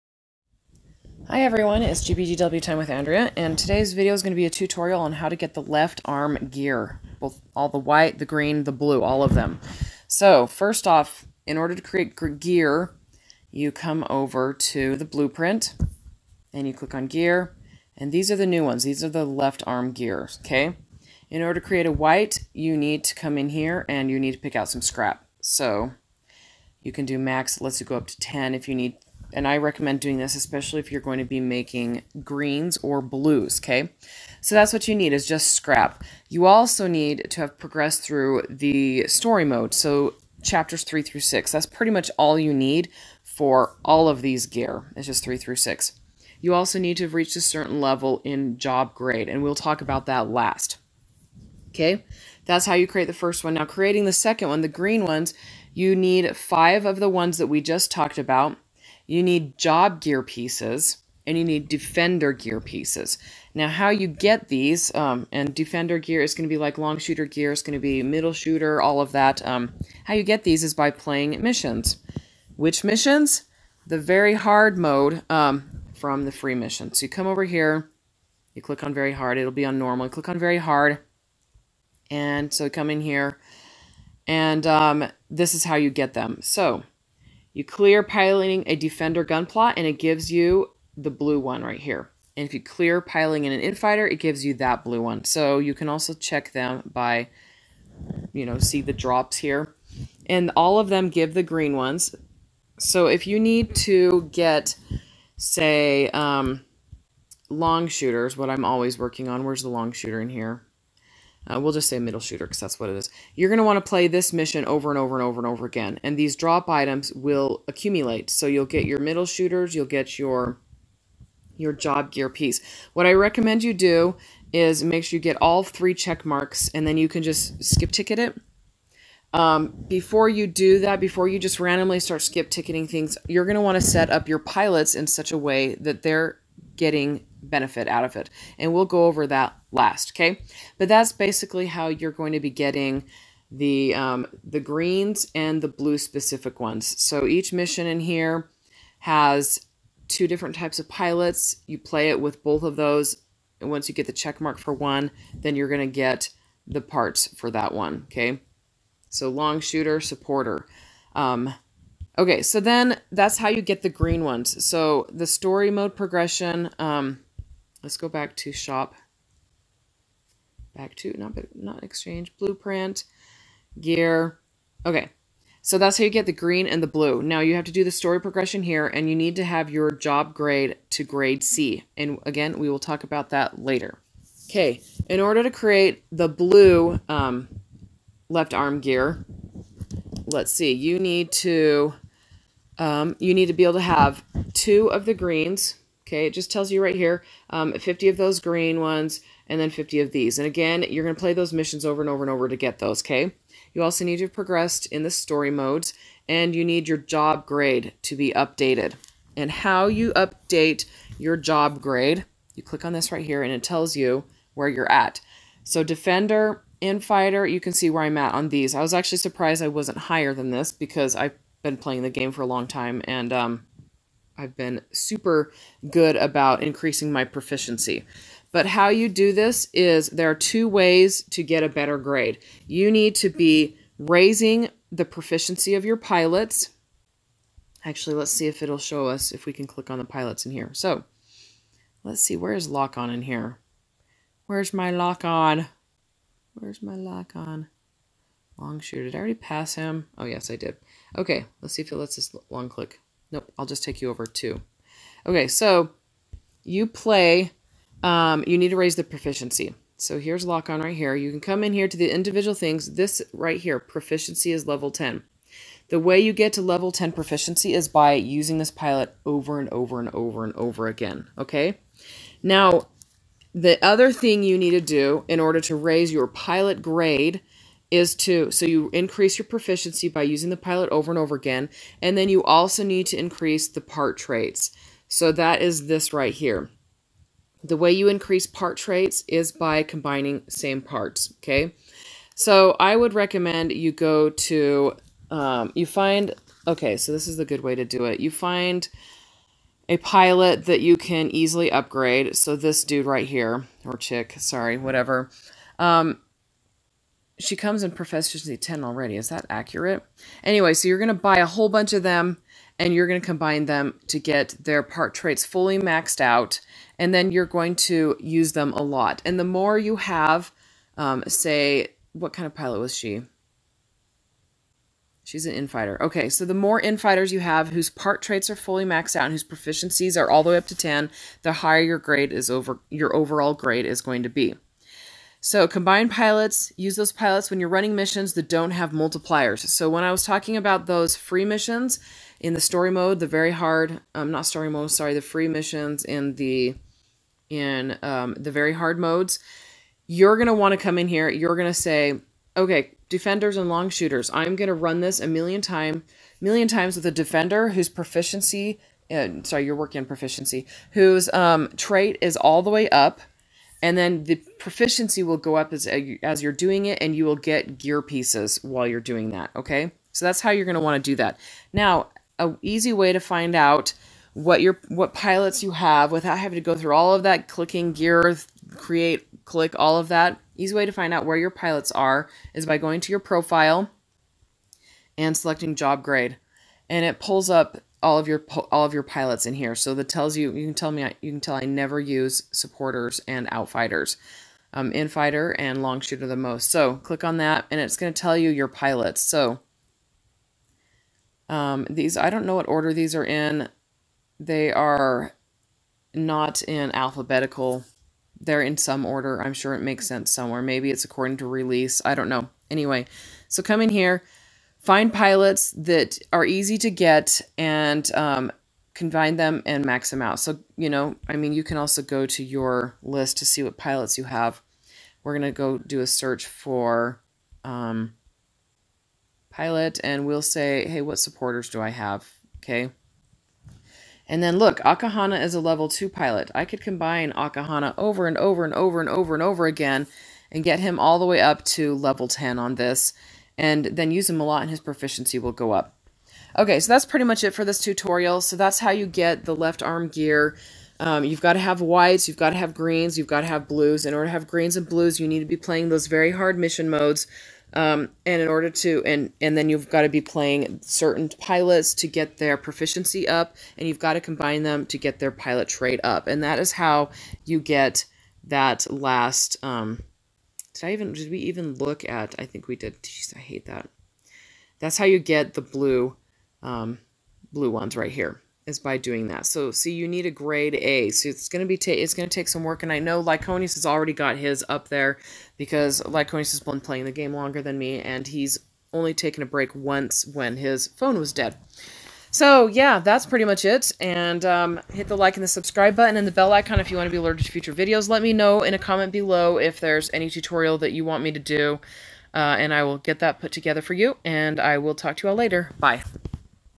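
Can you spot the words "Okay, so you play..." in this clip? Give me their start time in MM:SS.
04:15.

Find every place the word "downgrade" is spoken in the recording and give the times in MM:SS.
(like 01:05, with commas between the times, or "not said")
not said.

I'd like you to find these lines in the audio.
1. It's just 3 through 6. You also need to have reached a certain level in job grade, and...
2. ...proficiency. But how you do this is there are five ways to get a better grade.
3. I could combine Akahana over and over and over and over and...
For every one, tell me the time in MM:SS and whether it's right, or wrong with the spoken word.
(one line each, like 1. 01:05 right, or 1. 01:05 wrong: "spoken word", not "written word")
1. 00:44 right
2. 03:47 wrong: "two", not "five"
3. 07:16 right.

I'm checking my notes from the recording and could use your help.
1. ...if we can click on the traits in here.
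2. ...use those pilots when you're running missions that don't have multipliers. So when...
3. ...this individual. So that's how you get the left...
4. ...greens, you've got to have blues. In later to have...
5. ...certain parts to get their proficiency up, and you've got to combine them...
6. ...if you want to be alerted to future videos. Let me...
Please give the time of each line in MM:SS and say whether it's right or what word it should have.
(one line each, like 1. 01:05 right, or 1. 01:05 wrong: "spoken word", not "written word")
1. 03:59 wrong: "pilots", not "traits"
2. 05:36 right
3. 07:27 wrong: "tutorial", not "individual"
4. 07:32 wrong: "order", not "later"
5. 07:40 wrong: "pilots", not "parts"
6. 08:16 right.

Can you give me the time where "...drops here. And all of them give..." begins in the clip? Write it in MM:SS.
01:38.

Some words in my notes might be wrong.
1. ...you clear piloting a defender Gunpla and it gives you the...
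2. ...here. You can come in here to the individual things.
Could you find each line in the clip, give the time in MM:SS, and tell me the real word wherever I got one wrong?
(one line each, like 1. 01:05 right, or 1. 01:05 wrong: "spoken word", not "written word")
1. 01:27 right
2. 04:20 right.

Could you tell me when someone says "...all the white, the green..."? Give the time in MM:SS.
00:07.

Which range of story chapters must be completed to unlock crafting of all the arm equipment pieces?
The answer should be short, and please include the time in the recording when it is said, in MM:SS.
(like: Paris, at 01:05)
3 through 6, at 00:40.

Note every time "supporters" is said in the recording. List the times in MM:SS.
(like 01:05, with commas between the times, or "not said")
02:39, 06:32, 07:11.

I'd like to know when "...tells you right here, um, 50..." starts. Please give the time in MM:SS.
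03:16.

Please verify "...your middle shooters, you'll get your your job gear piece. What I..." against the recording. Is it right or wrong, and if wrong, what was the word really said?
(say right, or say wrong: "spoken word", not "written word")
right.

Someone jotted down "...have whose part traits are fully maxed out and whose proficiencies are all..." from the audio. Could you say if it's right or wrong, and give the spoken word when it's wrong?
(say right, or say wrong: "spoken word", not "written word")
right.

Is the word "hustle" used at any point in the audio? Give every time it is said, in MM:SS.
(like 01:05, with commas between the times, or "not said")
not said.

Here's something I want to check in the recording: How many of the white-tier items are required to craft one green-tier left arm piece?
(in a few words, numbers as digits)
5.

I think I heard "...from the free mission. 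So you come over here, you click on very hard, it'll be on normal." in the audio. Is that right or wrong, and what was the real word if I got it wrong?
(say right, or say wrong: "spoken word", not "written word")
right.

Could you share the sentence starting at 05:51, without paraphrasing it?
You're gonna say, okay, defenders and long shooters.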